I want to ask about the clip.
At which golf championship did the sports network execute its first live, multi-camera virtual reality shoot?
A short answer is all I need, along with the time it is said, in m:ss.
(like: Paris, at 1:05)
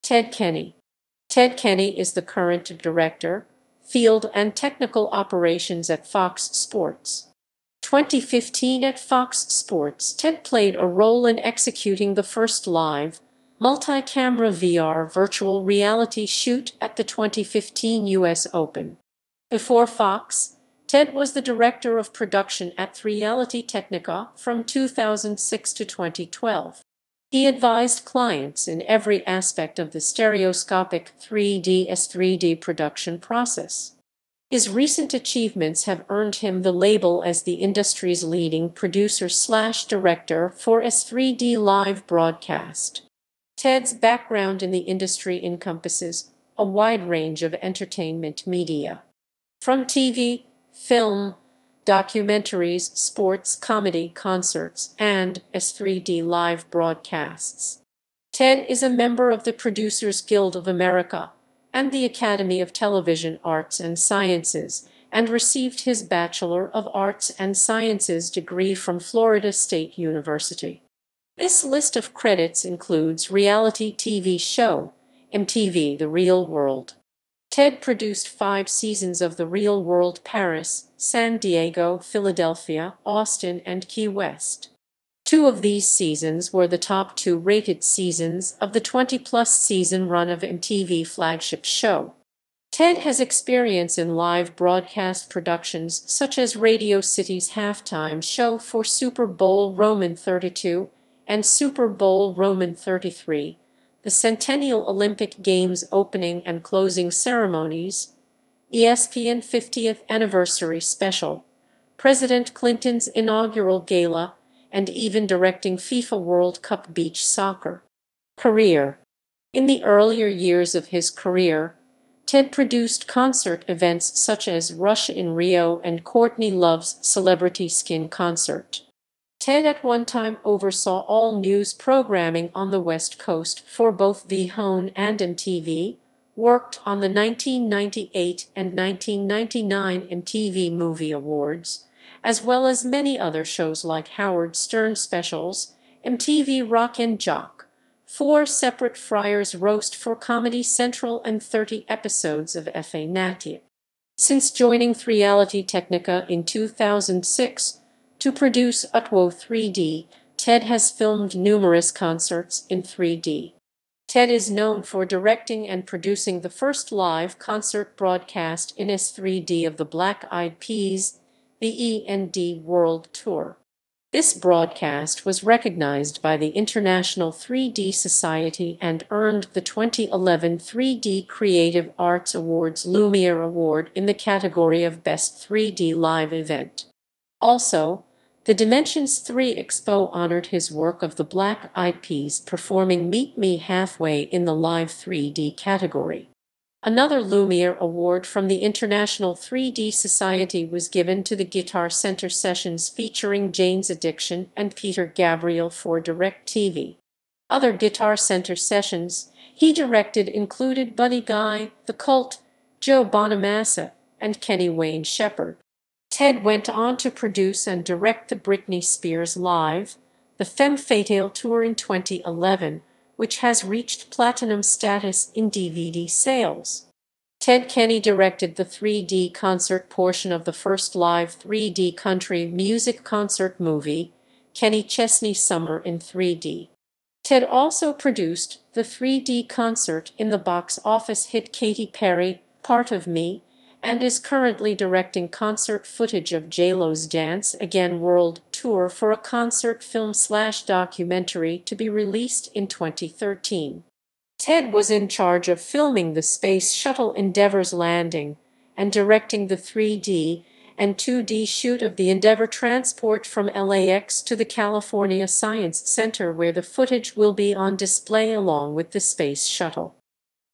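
2015 U.S. Open, at 0:17.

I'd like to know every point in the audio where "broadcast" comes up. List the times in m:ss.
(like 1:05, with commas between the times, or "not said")
0:42, 0:56, 1:34, 2:47, 2:54.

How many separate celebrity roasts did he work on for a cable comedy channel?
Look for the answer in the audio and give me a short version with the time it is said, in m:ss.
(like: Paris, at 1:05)
4, at 2:28.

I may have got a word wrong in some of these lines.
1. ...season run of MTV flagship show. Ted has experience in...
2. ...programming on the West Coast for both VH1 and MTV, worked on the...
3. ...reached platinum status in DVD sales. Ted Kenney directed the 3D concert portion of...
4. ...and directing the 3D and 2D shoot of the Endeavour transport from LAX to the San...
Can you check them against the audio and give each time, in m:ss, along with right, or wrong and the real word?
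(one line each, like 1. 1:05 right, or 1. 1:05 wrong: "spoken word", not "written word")
1. 1:29 right
2. 2:11 right
3. 3:43 right
4. 4:18 wrong: "California", not "San".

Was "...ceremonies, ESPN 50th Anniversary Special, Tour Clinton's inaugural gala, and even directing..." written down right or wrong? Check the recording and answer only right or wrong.
wrong.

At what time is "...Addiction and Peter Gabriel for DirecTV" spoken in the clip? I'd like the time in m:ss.
3:23.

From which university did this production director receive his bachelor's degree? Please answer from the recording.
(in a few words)
Florida State University.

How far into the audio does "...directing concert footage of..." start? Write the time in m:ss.
4:04.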